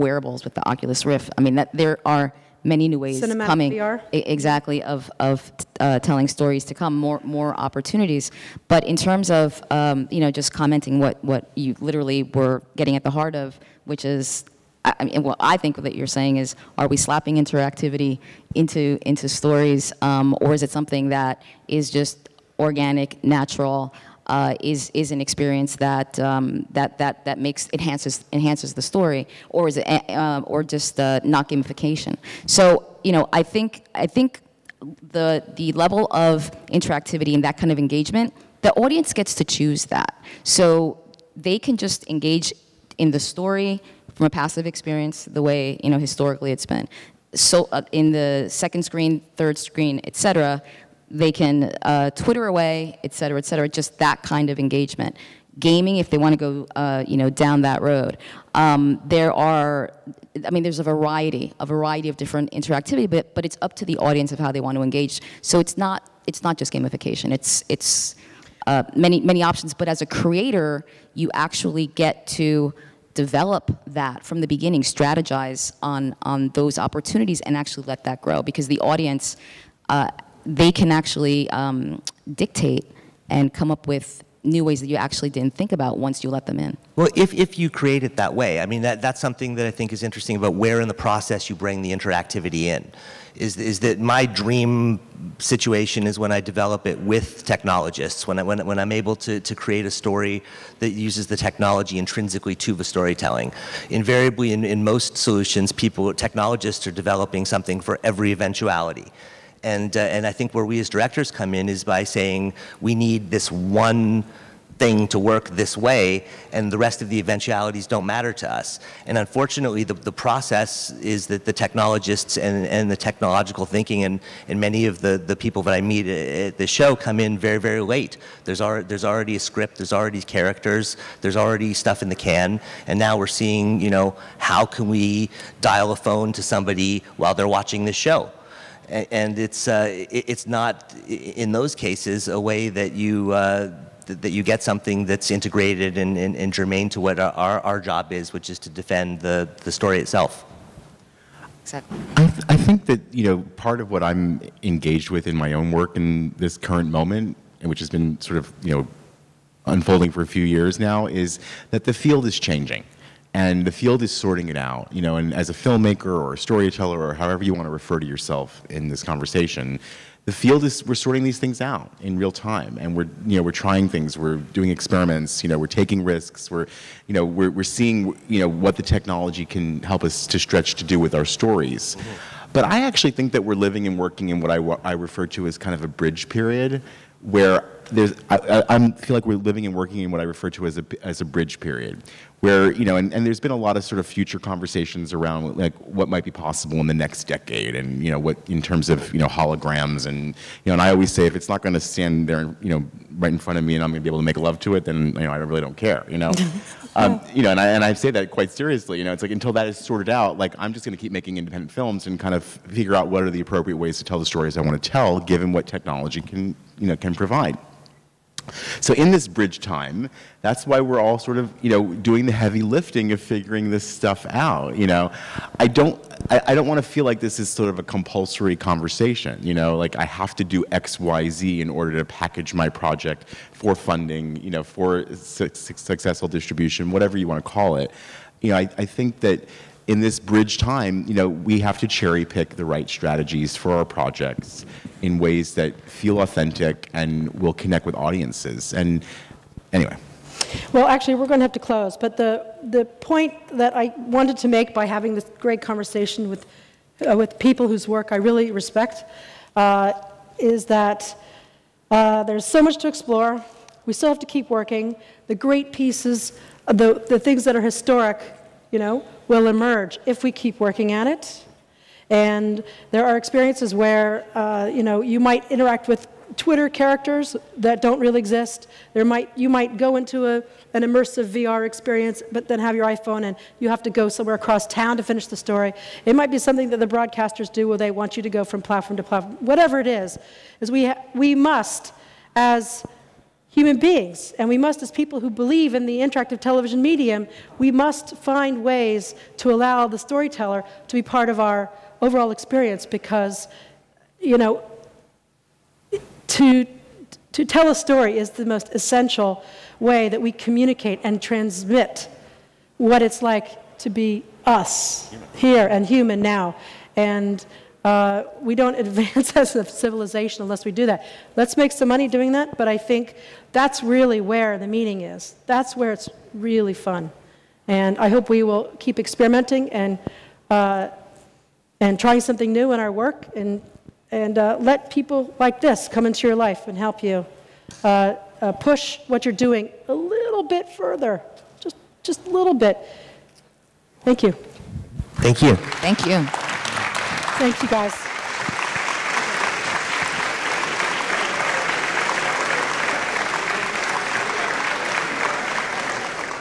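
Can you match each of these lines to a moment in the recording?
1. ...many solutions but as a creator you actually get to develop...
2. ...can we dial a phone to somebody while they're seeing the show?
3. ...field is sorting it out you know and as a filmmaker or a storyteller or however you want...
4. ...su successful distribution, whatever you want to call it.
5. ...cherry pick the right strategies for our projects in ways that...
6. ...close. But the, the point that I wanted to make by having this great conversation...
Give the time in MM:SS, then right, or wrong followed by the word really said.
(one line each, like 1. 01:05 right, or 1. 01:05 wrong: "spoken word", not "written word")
1. 01:09 wrong: "options", not "solutions"
2. 02:14 wrong: "watching", not "seeing"
3. 02:43 right
4. 03:55 right
5. 04:01 right
6. 04:11 right.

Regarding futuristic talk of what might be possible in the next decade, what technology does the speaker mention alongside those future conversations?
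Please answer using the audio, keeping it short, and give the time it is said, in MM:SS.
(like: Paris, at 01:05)
holograms, at 03:19.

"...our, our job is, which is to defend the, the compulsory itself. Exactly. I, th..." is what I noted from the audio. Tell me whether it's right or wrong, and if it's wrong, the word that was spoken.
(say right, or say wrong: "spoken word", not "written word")
wrong: "story", not "compulsory".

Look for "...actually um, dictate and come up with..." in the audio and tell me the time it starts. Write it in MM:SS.
01:20.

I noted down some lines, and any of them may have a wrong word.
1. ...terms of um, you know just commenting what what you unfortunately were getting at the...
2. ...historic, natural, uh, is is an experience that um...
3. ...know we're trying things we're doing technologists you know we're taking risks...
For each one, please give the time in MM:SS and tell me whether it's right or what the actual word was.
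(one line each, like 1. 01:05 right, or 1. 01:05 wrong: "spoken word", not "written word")
1. 00:08 wrong: "literally", not "unfortunately"
2. 00:22 wrong: "organic", not "historic"
3. 02:53 wrong: "experiments", not "technologists".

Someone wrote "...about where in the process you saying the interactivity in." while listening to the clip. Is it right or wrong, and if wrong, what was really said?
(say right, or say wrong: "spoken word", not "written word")
wrong: "bring", not "saying".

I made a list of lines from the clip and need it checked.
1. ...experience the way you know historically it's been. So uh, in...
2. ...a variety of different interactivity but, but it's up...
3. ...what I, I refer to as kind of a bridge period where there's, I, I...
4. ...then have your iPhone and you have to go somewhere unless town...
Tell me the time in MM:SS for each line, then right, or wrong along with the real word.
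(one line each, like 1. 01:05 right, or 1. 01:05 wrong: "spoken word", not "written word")
1. 00:44 right
2. 01:01 right
3. 03:04 right
4. 04:42 wrong: "across", not "unless".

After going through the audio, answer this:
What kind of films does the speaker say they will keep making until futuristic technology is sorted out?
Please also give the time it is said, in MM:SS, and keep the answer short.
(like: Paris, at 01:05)
independent films, at 03:31.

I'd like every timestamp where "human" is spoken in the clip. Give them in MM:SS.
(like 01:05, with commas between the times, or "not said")
04:53, 05:15.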